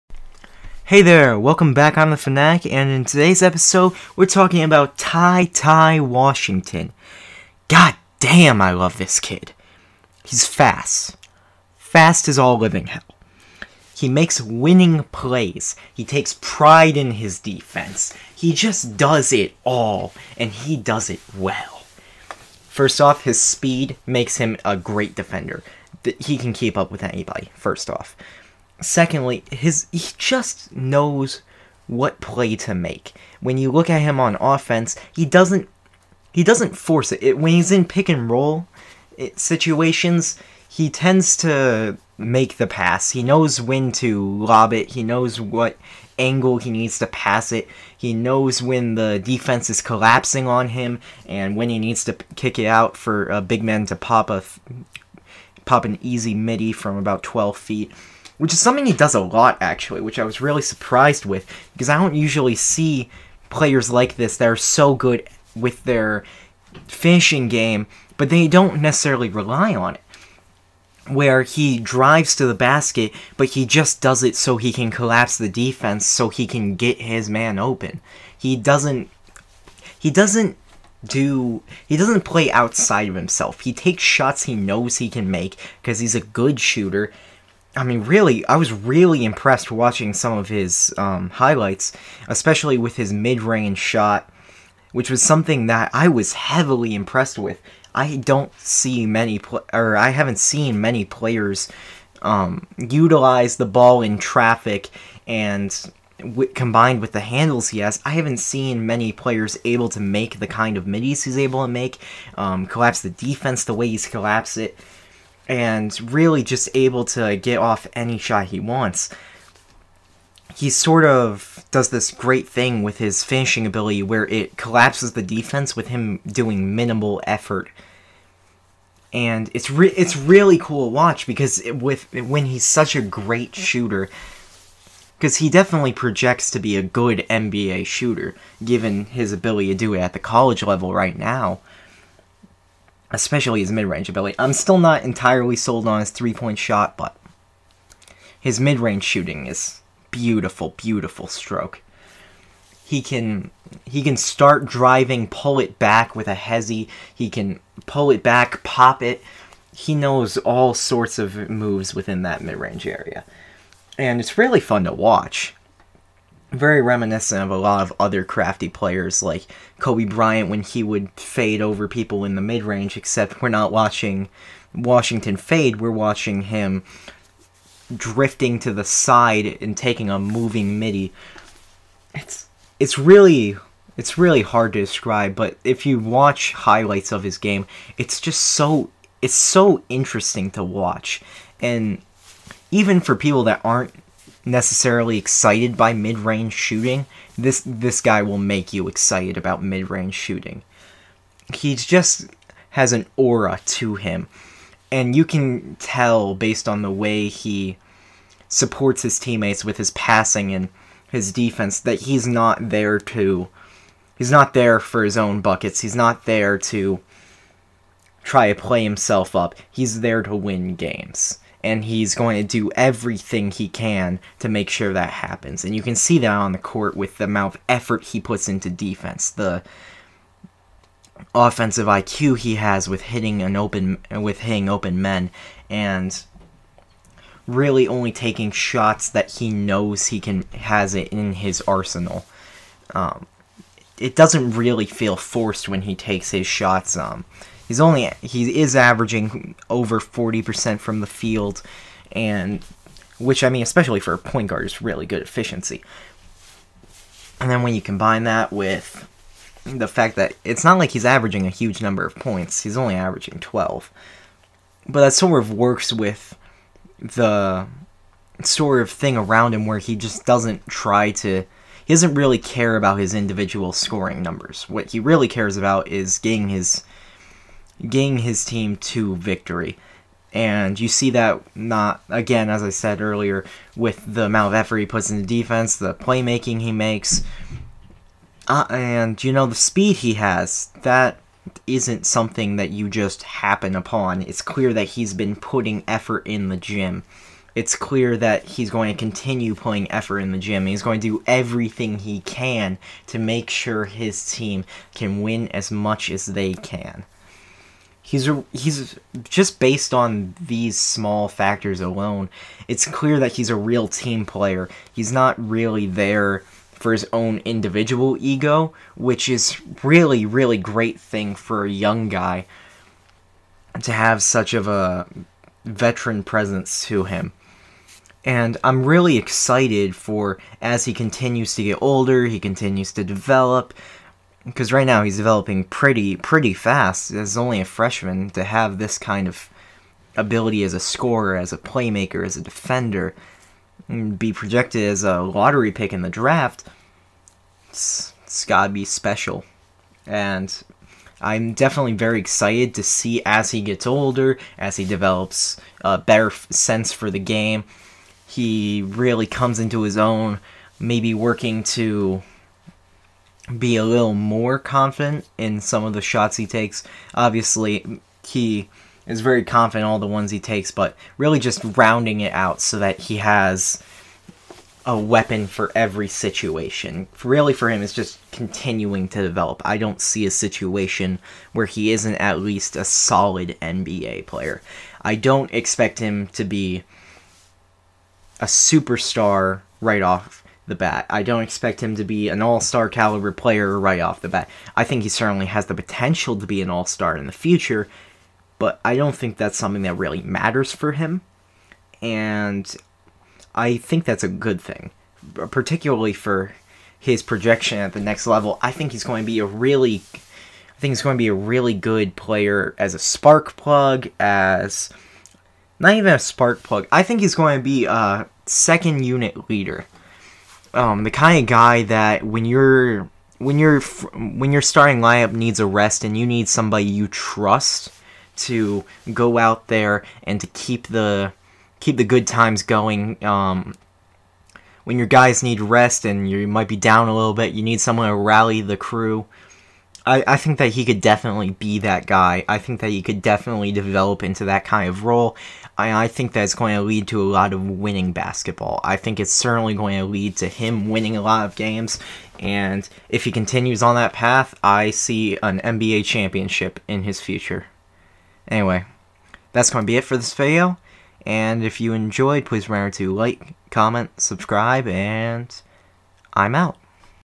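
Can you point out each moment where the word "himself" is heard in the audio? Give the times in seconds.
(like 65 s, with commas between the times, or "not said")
83 s, 218 s.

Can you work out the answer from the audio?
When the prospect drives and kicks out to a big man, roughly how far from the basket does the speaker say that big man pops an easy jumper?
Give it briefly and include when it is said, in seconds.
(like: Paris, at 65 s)
12 feet, at 57 s.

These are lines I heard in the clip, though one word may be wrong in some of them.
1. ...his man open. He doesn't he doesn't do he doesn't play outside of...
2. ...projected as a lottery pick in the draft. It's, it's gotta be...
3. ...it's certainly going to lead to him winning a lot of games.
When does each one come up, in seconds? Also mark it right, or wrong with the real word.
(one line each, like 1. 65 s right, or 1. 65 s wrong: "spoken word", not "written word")
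1. 76 s right
2. 344 s right
3. 449 s right.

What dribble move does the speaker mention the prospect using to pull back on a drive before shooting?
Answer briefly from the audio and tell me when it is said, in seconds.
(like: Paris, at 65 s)
hezi, at 156 s.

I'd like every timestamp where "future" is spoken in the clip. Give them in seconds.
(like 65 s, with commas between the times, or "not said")
397 s, 457 s.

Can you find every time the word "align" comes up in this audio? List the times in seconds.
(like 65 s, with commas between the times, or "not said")
not said.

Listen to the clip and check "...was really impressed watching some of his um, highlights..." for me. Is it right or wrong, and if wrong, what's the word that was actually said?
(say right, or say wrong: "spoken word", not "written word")
right.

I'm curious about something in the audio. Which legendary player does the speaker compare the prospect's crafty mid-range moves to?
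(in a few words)
Kobe Bryant.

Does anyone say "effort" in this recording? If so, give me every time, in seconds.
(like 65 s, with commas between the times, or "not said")
127 s, 227 s, 284 s, 295 s, 299 s.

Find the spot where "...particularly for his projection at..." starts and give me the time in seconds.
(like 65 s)
405 s.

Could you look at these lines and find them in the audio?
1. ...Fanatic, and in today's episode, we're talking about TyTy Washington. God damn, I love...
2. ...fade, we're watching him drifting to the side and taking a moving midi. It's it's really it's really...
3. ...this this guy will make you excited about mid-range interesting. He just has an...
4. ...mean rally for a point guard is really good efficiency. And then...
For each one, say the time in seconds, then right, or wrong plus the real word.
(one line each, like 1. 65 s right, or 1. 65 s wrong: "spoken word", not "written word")
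1. 2 s right
2. 175 s right
3. 197 s wrong: "shooting", not "interesting"
4. 253 s wrong: "especially", not "rally".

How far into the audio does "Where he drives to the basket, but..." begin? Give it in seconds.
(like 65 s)
71 s.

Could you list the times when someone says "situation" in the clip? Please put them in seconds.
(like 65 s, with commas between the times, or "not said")
39 s, 376 s, 380 s.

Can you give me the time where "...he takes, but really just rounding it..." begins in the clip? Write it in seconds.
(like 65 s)
370 s.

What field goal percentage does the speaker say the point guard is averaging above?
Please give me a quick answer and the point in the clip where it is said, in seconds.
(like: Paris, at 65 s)
40%, at 250 s.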